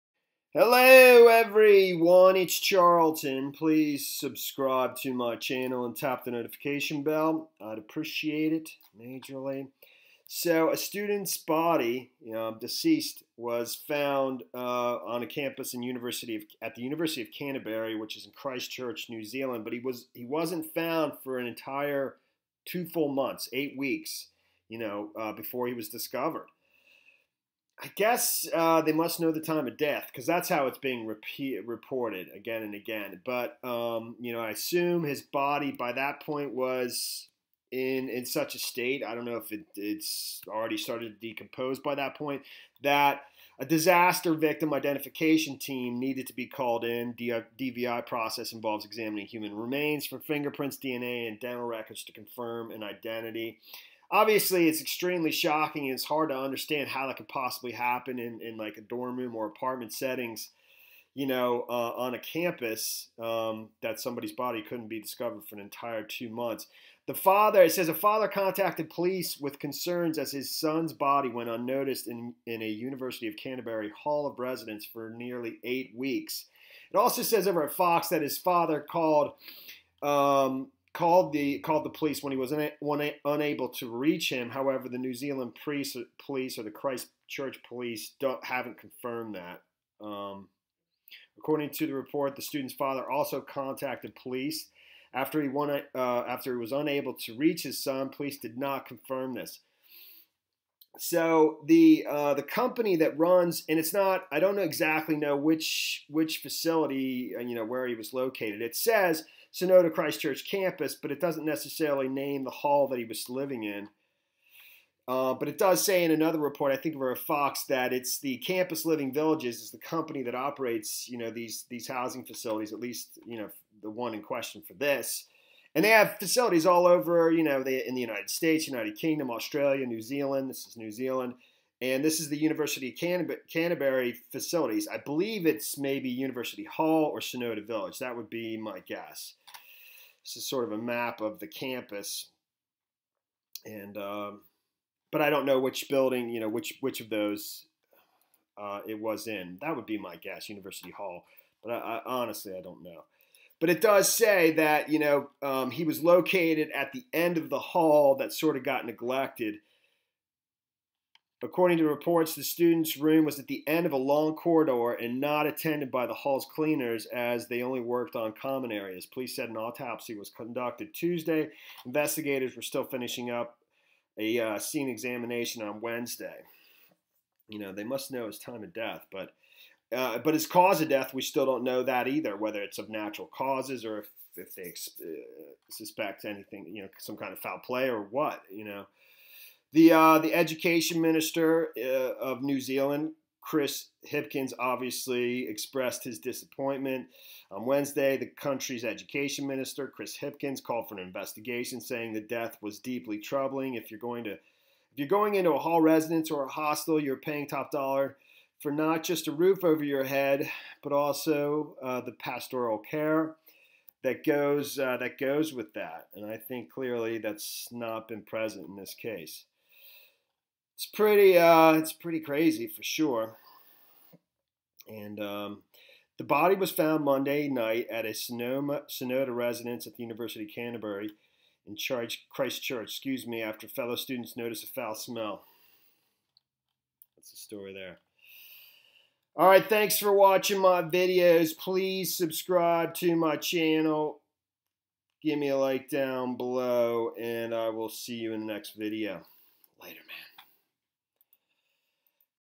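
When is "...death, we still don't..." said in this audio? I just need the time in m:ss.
3:00.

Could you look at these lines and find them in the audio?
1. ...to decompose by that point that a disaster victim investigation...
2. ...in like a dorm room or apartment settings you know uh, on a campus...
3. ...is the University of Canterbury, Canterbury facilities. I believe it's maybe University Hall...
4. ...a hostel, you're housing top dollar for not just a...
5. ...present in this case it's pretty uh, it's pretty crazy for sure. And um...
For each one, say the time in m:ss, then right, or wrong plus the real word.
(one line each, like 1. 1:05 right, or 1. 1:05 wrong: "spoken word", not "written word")
1. 0:41 wrong: "identification", not "investigation"
2. 0:58 right
3. 2:12 right
4. 3:26 wrong: "paying", not "housing"
5. 3:38 right.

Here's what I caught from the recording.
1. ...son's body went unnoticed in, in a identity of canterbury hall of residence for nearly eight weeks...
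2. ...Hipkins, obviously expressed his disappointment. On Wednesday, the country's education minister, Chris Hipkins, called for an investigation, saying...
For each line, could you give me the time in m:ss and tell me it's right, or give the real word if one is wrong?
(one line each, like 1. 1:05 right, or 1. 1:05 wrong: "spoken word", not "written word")
1. 1:10 wrong: "university", not "identity"
2. 3:14 right.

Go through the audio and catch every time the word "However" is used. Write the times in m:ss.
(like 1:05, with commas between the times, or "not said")
1:24.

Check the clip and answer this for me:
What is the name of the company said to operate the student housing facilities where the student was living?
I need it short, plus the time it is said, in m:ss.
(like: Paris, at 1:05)
Campus Living Villages, at 1:58.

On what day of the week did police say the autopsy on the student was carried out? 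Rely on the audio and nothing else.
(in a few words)
Tuesday.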